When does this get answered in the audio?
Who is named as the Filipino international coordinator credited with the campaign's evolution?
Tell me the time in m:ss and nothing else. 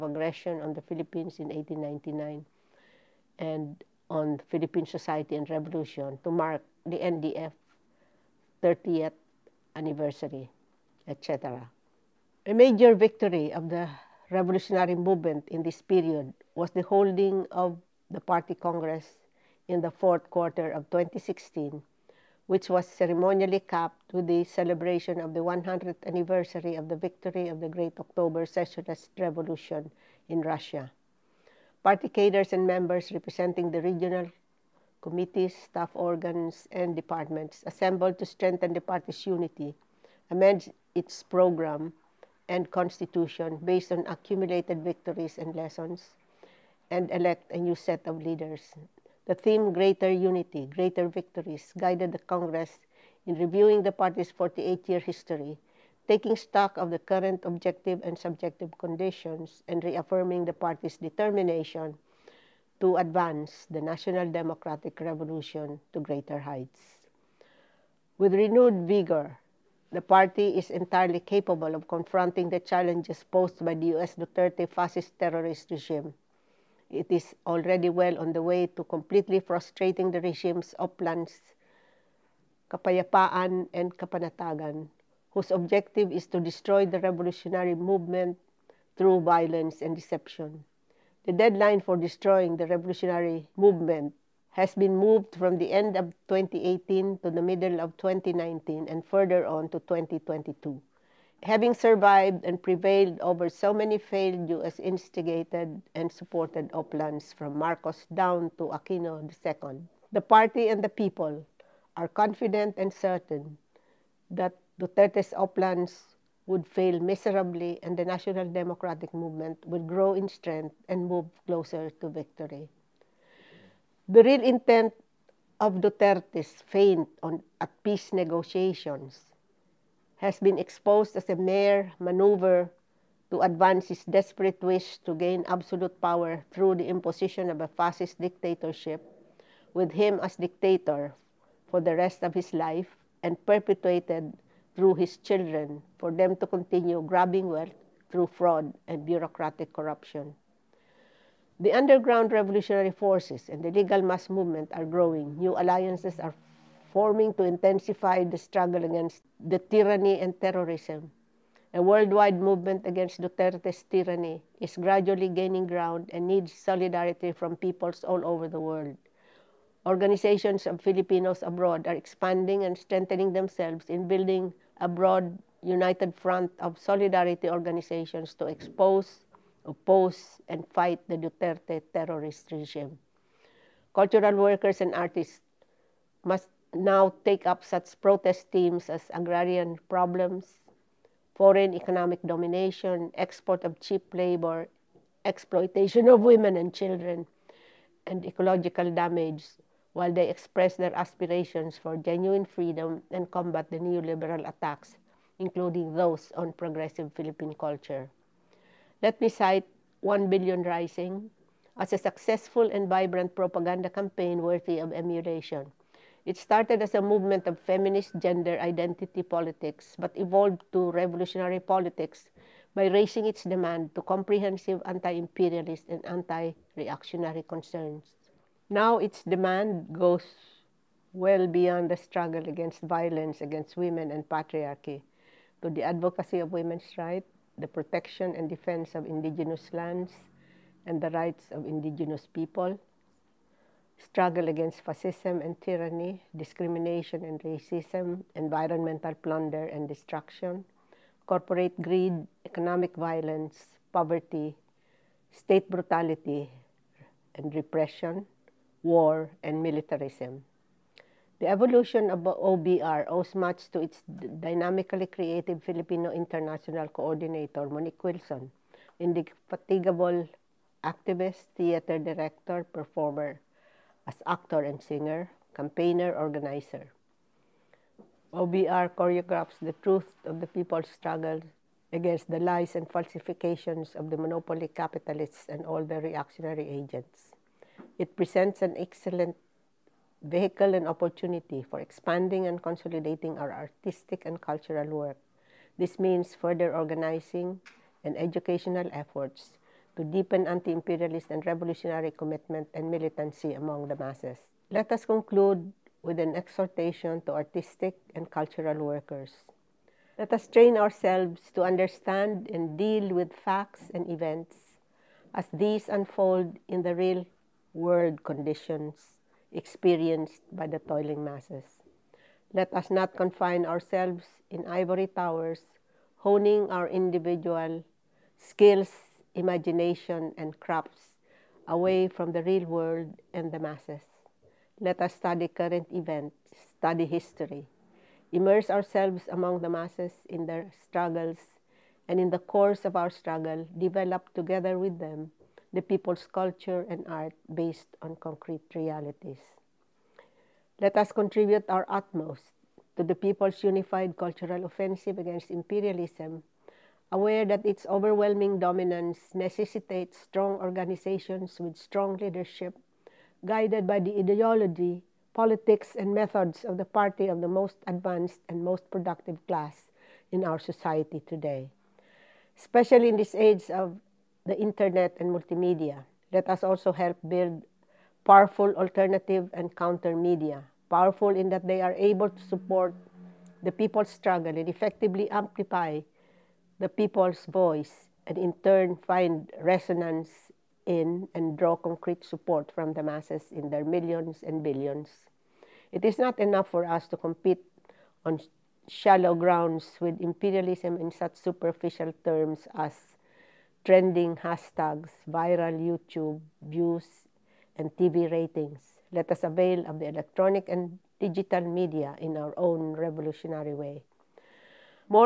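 4:27.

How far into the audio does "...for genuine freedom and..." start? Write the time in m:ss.
3:21.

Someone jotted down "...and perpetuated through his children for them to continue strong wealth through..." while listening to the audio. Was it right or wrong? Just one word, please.
wrong.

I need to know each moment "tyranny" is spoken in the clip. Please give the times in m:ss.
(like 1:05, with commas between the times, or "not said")
2:39, 2:43, 4:05.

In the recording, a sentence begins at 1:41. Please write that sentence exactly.
having survived and prevailed over so many failed U.S.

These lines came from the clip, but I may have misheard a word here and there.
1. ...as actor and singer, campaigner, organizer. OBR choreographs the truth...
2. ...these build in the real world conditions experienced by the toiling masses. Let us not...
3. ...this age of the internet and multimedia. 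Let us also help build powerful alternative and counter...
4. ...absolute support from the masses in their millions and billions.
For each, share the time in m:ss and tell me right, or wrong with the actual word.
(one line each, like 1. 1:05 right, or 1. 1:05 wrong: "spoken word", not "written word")
1. 4:34 right
2. 5:15 wrong: "unfold", not "build"
3. 6:13 right
4. 6:31 wrong: "concrete", not "absolute".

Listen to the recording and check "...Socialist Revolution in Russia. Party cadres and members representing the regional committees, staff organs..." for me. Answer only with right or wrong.
right.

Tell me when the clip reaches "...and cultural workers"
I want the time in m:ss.
5:08.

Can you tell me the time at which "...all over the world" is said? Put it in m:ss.
2:48.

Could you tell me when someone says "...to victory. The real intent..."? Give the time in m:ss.
2:02.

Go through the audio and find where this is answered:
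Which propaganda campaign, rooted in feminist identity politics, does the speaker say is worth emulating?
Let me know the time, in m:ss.
3:30.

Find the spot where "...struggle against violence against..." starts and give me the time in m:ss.
3:51.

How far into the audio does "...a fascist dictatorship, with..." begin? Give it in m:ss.
2:17.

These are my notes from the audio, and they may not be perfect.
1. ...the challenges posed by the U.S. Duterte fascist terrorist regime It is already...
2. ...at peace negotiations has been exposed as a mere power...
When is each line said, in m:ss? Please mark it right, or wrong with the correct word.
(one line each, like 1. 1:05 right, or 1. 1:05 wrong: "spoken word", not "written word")
1. 1:12 right
2. 2:07 wrong: "maneuver", not "power".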